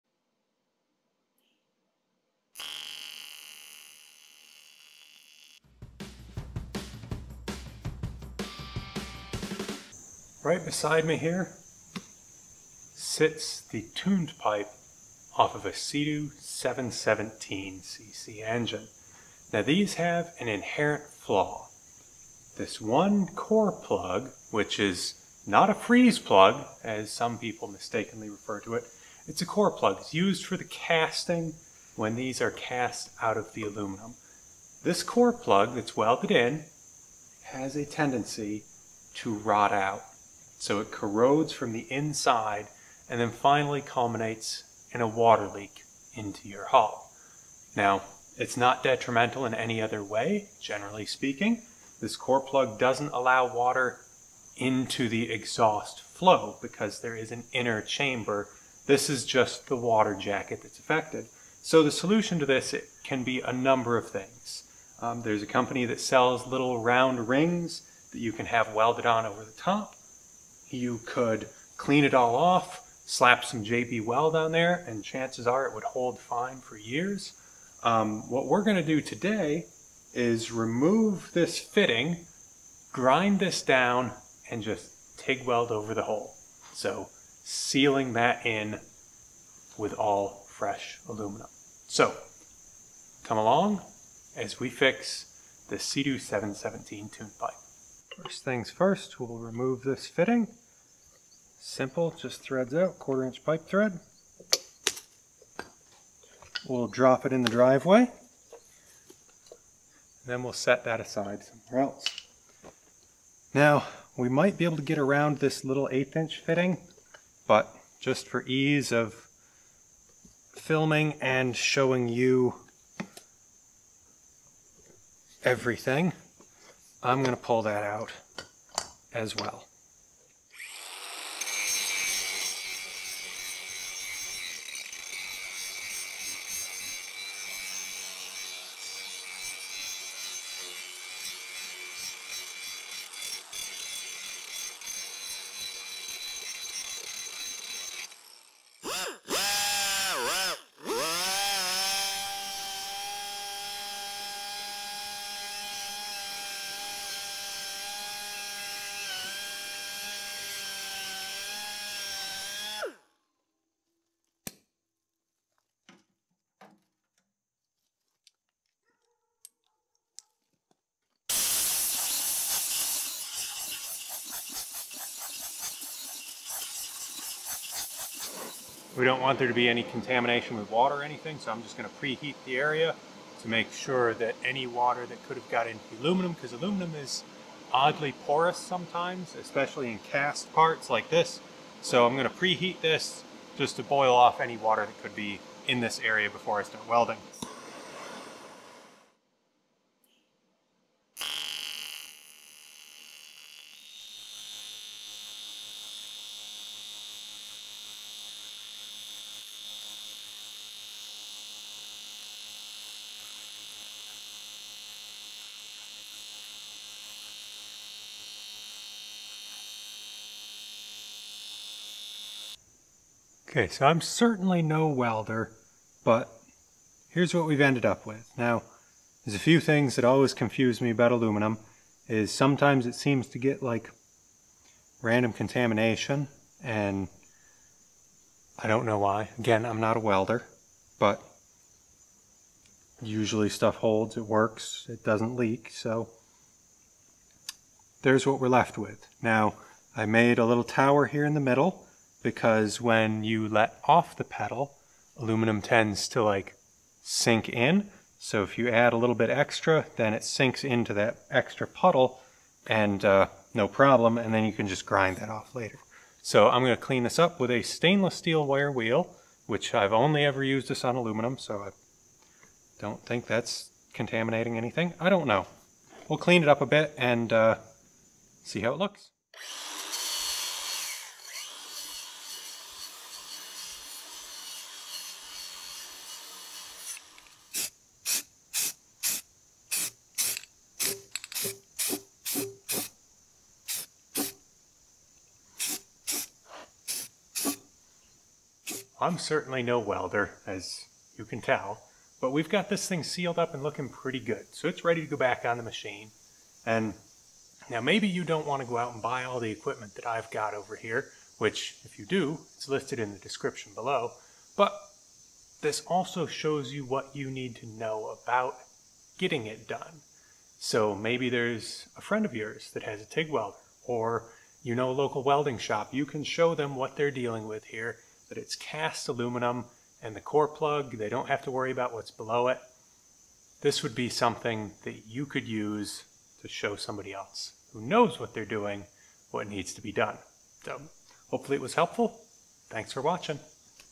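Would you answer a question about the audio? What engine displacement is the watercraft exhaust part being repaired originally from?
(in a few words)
717cc.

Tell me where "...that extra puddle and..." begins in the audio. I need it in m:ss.
4:20.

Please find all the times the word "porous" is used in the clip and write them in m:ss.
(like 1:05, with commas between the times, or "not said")
3:08.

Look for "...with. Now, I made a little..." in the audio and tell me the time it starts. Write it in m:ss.
4:08.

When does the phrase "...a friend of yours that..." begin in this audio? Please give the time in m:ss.
5:21.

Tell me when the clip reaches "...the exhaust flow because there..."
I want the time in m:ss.
0:55.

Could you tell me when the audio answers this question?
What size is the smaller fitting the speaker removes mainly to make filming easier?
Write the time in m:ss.
1:55.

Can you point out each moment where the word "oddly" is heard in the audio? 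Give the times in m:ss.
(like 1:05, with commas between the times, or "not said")
3:07.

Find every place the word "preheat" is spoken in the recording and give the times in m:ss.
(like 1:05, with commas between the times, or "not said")
3:01, 3:12.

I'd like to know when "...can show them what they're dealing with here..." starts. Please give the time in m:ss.
5:26.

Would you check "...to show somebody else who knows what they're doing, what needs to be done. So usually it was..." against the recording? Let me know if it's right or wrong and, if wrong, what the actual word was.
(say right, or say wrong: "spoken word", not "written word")
wrong: "hopefully", not "usually".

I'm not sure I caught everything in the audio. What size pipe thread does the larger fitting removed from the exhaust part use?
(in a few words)
quarter inch.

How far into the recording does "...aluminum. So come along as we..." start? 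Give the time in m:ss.
1:31.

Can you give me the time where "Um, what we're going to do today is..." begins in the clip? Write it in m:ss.
1:17.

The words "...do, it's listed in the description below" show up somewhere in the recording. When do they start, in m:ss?
5:12.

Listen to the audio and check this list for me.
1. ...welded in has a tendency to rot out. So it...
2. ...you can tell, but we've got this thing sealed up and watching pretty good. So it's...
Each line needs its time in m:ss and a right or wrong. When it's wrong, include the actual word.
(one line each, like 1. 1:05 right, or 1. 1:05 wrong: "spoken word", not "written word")
1. 0:35 right
2. 5:01 wrong: "looking", not "watching".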